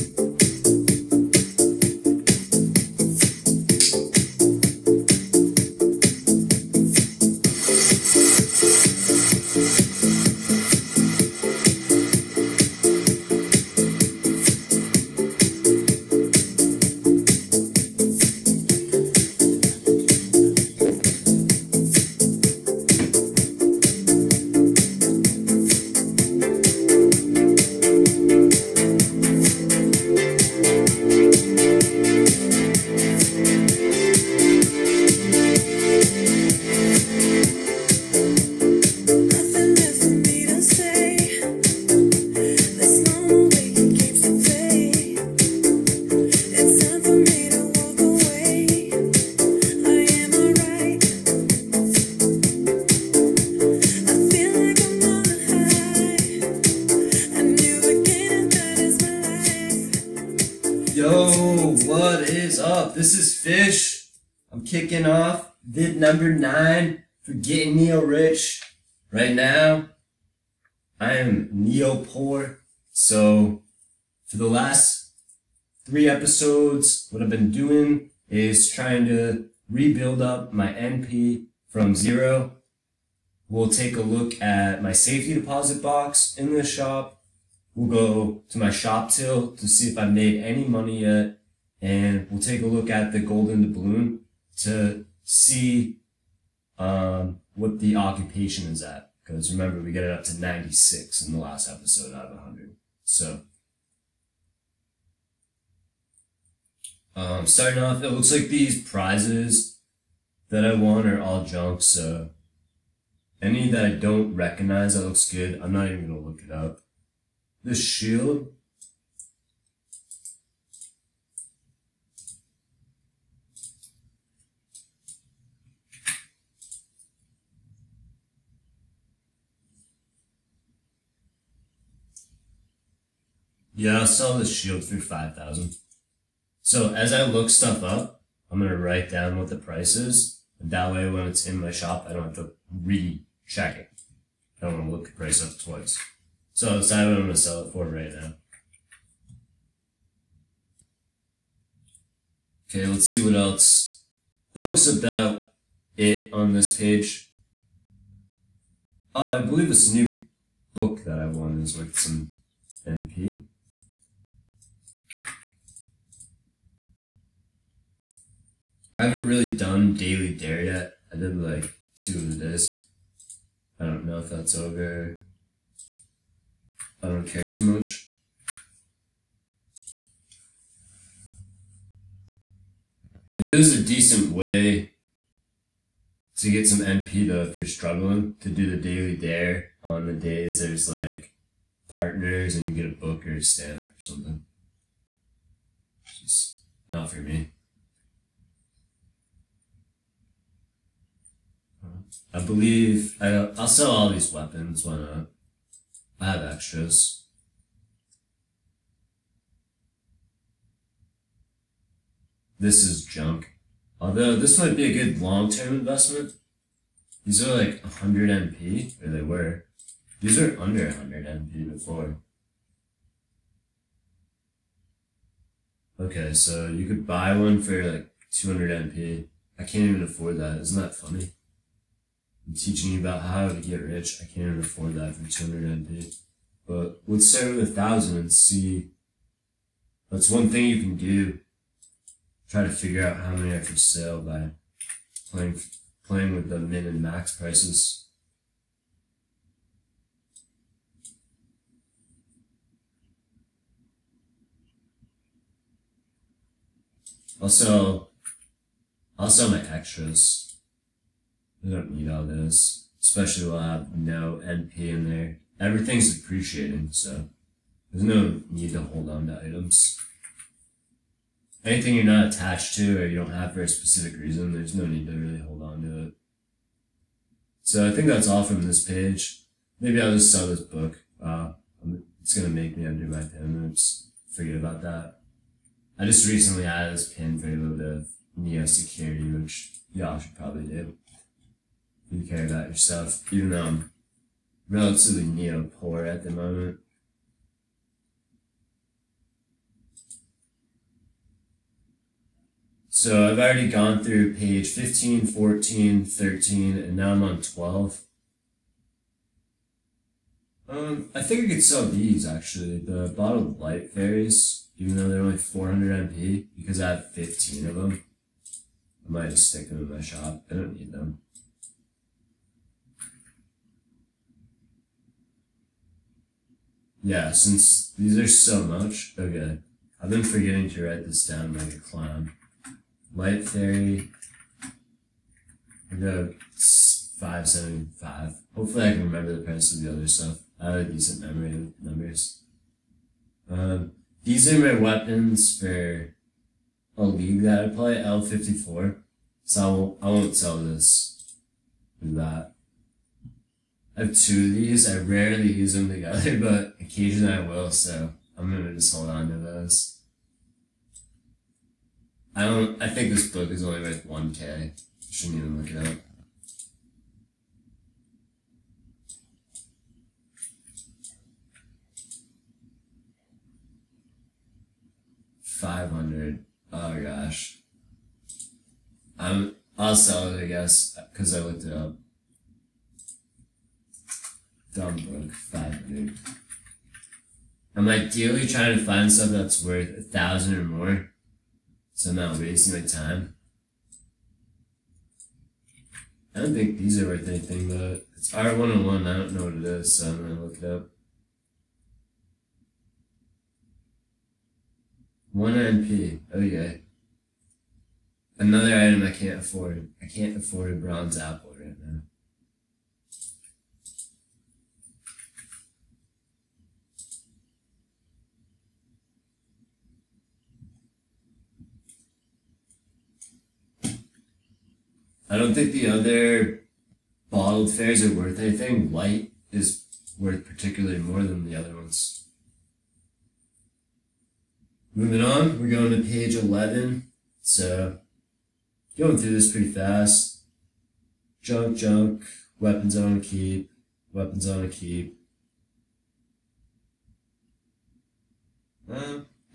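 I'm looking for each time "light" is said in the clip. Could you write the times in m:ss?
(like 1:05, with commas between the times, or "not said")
5:13, 5:33, 7:08.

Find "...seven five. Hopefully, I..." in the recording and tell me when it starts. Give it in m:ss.
5:37.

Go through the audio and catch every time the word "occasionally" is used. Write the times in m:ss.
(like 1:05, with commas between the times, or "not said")
5:56.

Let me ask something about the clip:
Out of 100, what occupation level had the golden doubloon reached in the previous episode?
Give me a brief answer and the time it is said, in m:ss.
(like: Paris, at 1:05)
96, at 1:40.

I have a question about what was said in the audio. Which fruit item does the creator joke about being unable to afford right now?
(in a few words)
bronze apple.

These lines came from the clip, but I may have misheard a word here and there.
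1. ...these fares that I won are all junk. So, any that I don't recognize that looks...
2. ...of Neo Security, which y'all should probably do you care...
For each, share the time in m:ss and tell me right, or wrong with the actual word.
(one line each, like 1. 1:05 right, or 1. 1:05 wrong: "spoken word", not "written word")
1. 1:48 wrong: "prizes", not "fares"
2. 4:48 right.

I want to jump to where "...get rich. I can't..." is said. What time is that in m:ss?
3:53.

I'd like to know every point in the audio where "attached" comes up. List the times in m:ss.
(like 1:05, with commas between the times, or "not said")
4:32.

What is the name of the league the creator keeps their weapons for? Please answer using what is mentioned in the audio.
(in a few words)
L54.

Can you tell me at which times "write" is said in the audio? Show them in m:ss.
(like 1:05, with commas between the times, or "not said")
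2:18, 5:30.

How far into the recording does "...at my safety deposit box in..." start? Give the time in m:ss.
1:24.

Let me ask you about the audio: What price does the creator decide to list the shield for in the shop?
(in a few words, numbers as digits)
5,000.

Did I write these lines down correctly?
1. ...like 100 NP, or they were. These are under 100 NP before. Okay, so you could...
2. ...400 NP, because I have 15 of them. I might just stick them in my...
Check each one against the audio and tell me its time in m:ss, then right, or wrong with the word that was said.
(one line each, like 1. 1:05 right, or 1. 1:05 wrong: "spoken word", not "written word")
1. 3:37 right
2. 5:15 right.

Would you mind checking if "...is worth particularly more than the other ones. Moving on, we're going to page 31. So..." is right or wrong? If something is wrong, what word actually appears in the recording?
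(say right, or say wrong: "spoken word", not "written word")
wrong: "11", not "31".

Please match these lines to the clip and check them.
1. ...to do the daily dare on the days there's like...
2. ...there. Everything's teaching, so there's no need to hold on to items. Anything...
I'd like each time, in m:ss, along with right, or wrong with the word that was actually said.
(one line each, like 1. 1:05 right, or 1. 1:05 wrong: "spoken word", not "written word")
1. 3:08 right
2. 4:25 wrong: "depreciating", not "teaching".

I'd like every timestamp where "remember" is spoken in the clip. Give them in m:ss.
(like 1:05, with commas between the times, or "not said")
1:39, 5:39.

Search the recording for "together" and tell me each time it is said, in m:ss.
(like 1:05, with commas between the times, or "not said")
5:55.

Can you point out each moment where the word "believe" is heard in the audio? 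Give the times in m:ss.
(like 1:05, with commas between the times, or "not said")
2:39, 3:22.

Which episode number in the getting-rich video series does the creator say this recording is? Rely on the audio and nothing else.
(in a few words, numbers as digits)
9.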